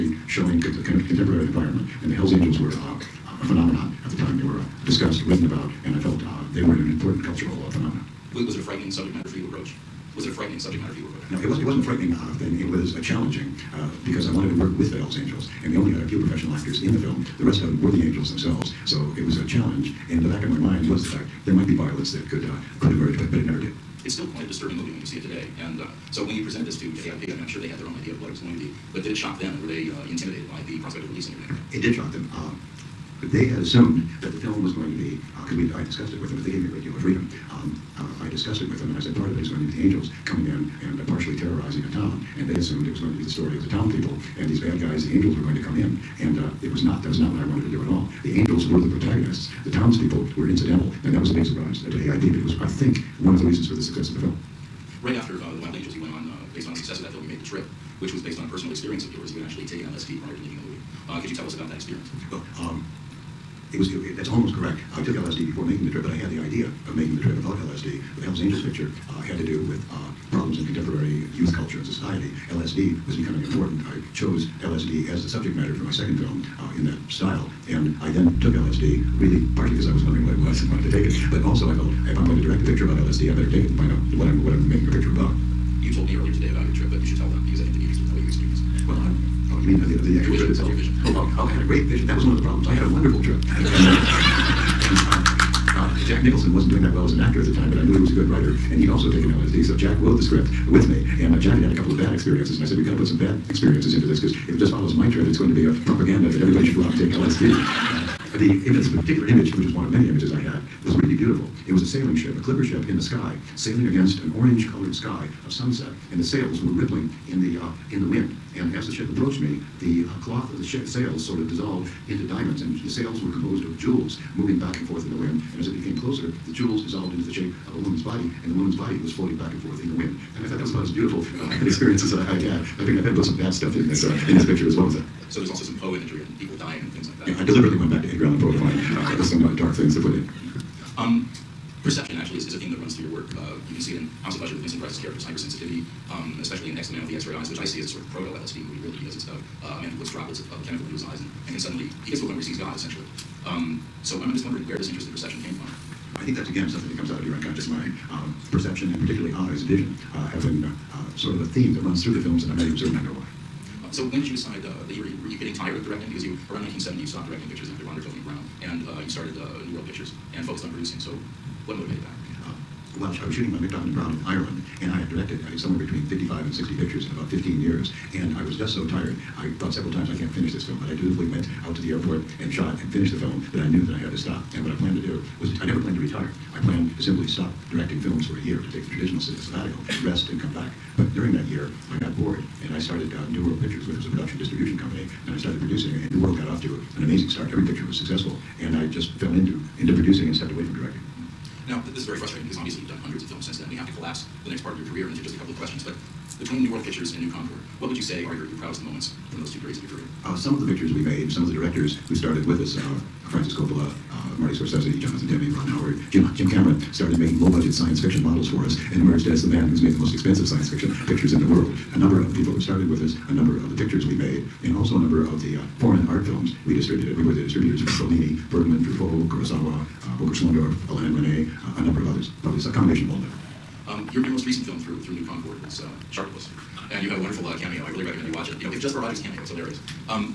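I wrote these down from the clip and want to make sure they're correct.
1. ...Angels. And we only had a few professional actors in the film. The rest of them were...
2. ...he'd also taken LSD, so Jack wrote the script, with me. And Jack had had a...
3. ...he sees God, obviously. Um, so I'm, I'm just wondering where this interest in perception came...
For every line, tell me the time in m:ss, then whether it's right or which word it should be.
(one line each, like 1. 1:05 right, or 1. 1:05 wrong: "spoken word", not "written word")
1. 0:15 right
2. 1:38 right
3. 2:32 wrong: "essentially", not "obviously".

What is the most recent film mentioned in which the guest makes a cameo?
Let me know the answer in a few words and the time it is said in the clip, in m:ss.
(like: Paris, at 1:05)
Sharktopus, at 3:56.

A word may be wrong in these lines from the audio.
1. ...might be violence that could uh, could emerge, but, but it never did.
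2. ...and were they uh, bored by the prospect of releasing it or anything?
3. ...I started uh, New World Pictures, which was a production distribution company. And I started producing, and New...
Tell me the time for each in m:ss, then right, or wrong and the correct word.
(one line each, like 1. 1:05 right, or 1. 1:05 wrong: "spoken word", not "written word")
1. 0:21 right
2. 0:29 wrong: "intimidated", not "bored"
3. 3:12 right.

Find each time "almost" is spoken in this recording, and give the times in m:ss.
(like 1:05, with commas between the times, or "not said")
1:04.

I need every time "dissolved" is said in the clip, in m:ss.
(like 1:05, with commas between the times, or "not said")
2:01, 2:06.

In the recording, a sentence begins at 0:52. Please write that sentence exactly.
But it was, I think, one of the reasons for the success of the film.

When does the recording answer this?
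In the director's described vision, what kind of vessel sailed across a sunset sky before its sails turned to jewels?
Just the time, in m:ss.
1:52.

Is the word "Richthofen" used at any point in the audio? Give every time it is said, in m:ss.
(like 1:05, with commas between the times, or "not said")
2:47, 2:53.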